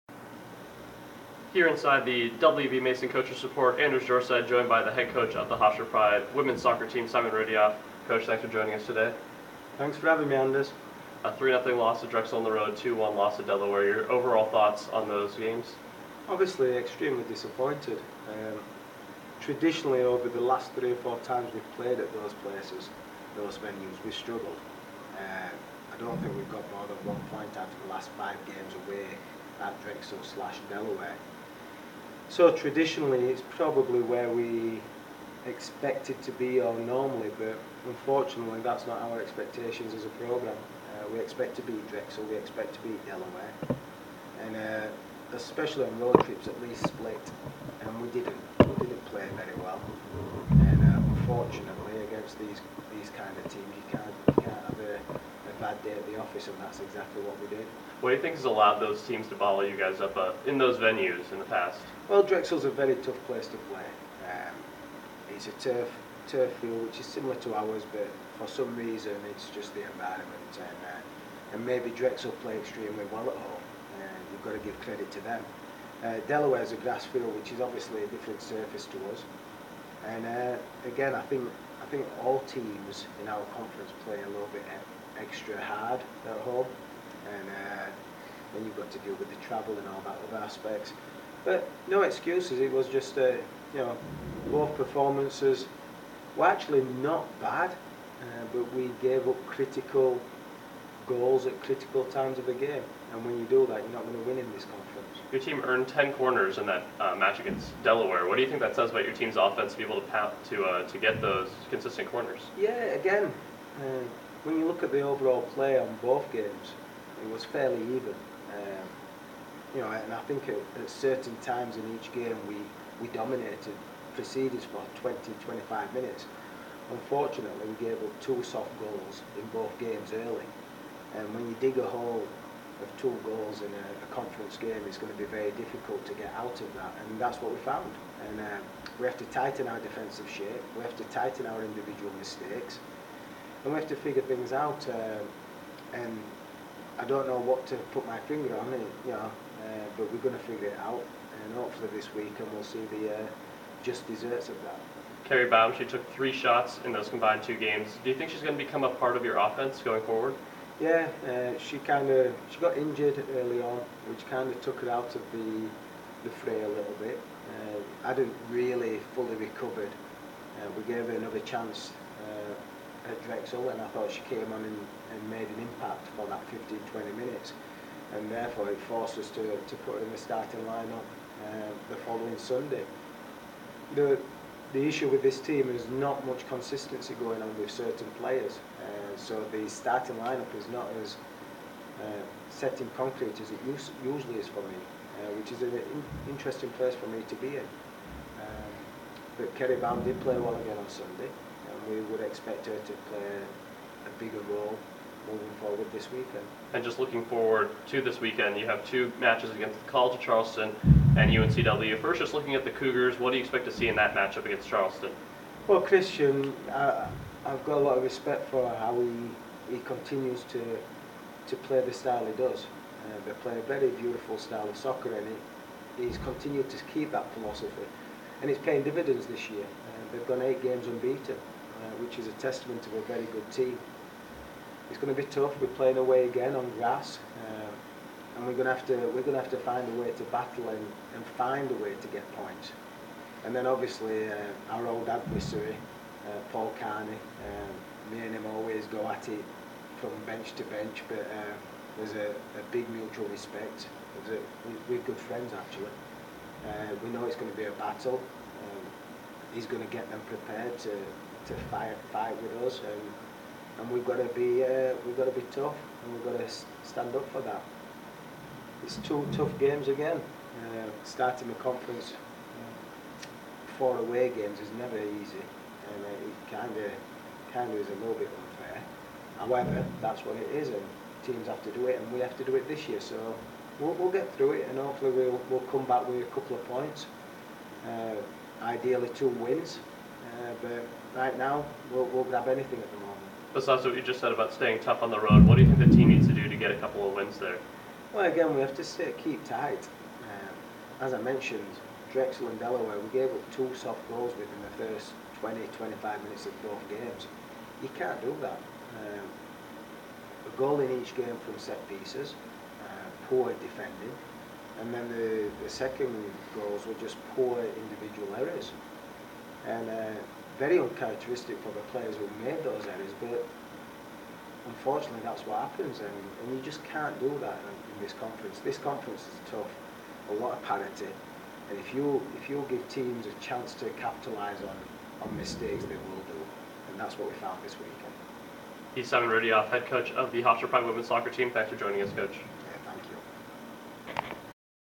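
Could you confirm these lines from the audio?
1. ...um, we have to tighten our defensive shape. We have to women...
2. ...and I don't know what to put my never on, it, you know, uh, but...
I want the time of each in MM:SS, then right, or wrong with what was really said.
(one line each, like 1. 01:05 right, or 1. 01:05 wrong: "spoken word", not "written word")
1. 02:18 wrong: "tighten", not "women"
2. 02:26 wrong: "finger", not "never".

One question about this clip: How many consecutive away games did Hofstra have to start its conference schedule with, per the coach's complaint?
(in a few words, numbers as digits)
4.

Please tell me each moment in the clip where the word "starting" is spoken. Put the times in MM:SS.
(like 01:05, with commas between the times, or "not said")
03:00, 03:09, 04:31.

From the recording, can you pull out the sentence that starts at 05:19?
And uh, very uncharacteristic for the players who made those errors, but unfortunately that's what happens.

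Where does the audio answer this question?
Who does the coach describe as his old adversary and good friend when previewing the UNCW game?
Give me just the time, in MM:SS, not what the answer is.
04:06.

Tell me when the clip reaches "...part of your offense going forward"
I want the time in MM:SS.
02:38.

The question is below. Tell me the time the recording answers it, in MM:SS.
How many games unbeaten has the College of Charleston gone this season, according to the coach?
03:50.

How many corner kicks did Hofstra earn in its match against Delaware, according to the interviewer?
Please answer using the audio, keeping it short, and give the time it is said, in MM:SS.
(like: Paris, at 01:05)
10, at 01:45.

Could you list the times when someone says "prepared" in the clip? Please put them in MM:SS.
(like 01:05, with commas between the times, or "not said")
04:20.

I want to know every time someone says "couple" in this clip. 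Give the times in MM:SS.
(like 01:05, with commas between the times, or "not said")
04:46, 04:56.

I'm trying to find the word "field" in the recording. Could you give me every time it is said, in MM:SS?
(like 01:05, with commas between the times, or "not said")
01:06, 01:17.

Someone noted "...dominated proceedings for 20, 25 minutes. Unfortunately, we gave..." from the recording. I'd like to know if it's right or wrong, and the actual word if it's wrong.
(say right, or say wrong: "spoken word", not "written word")
right.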